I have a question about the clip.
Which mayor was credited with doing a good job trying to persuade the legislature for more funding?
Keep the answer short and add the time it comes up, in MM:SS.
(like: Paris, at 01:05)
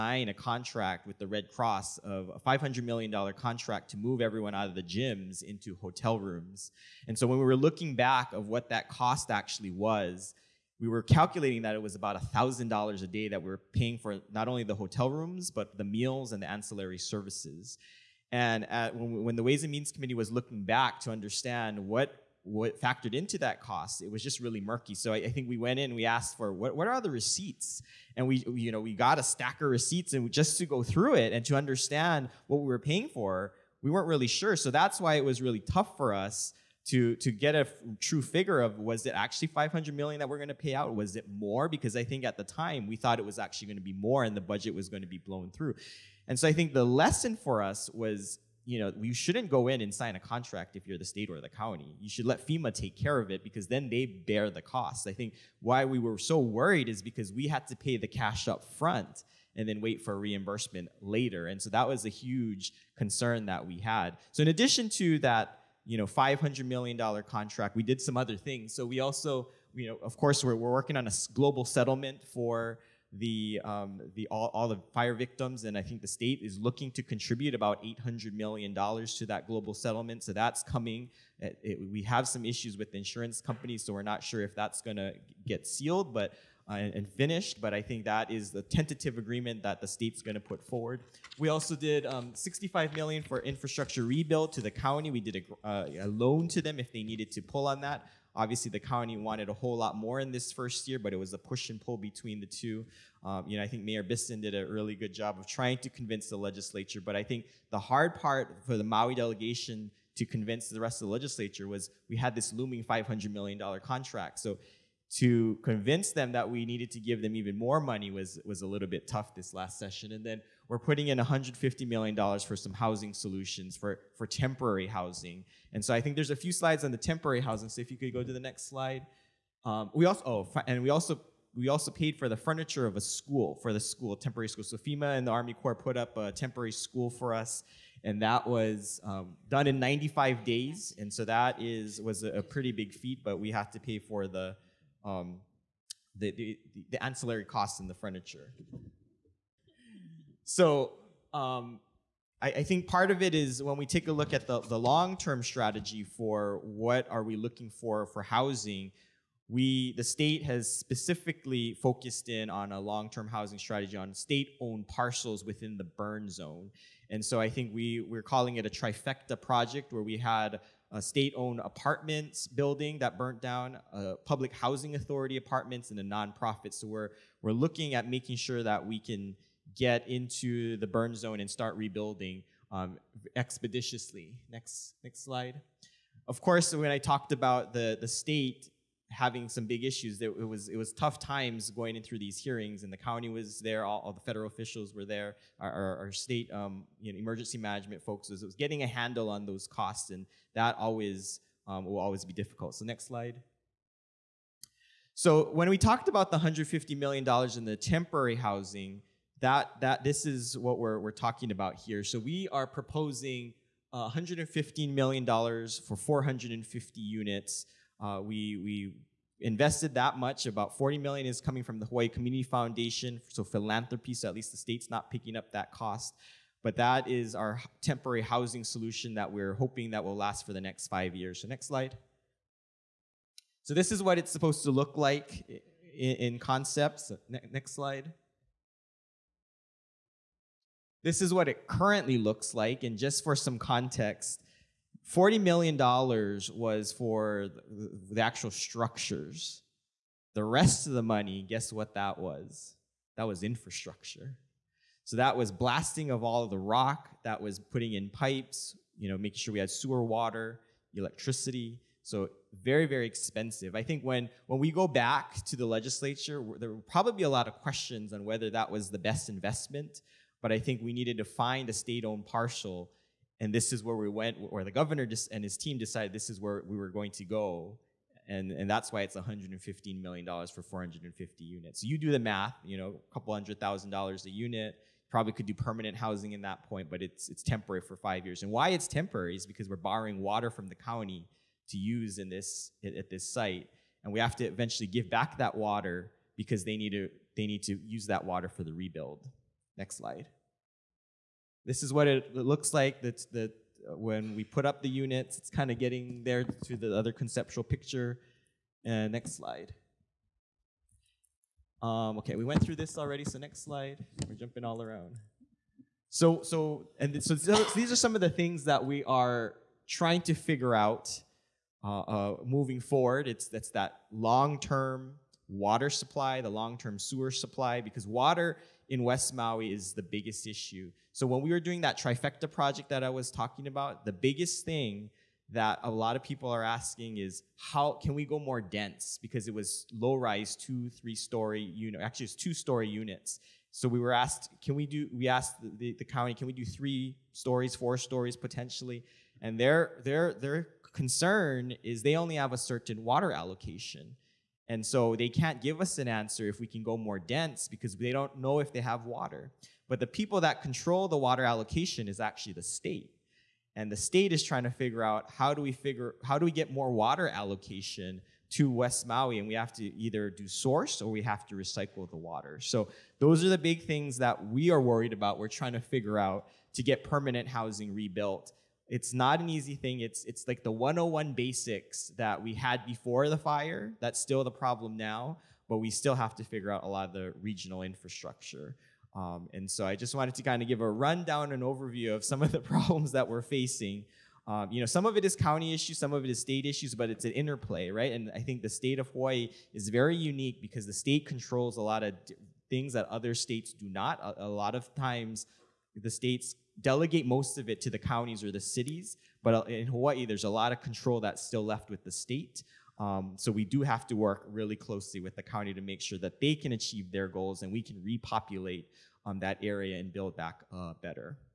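Mayor Bissen, at 01:43.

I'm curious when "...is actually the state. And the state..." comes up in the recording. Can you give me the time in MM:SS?
06:02.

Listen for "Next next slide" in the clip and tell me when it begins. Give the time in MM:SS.
03:04.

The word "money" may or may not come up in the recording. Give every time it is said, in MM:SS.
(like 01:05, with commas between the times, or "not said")
01:57, 04:11.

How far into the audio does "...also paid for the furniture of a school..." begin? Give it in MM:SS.
02:11.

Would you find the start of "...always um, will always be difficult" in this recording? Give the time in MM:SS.
03:20.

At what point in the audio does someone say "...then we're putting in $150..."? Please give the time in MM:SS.
02:00.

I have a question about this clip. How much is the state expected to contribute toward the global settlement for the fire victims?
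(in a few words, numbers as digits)
$800 million.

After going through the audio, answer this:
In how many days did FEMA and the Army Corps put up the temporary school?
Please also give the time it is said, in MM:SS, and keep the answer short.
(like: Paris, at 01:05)
95, at 02:19.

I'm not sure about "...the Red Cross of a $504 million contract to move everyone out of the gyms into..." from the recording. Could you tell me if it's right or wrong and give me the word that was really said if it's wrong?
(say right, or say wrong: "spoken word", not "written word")
wrong: "500", not "504".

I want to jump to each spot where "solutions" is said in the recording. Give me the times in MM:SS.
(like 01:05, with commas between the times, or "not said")
02:03, 03:48.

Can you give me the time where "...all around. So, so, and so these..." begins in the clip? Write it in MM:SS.
05:14.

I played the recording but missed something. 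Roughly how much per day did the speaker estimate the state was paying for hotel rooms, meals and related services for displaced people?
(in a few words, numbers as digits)
$1,000.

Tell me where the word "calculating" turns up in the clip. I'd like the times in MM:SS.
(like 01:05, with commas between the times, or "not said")
00:11.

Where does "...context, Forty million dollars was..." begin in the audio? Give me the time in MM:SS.
04:03.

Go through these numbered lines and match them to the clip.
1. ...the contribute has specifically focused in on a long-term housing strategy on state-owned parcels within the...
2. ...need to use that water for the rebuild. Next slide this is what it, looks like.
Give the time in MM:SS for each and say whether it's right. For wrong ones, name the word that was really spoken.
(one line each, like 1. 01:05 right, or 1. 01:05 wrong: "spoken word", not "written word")
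1. 02:39 wrong: "state", not "contribute"
2. 04:57 right.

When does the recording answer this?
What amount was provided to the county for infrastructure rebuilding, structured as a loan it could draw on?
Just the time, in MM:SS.
01:32.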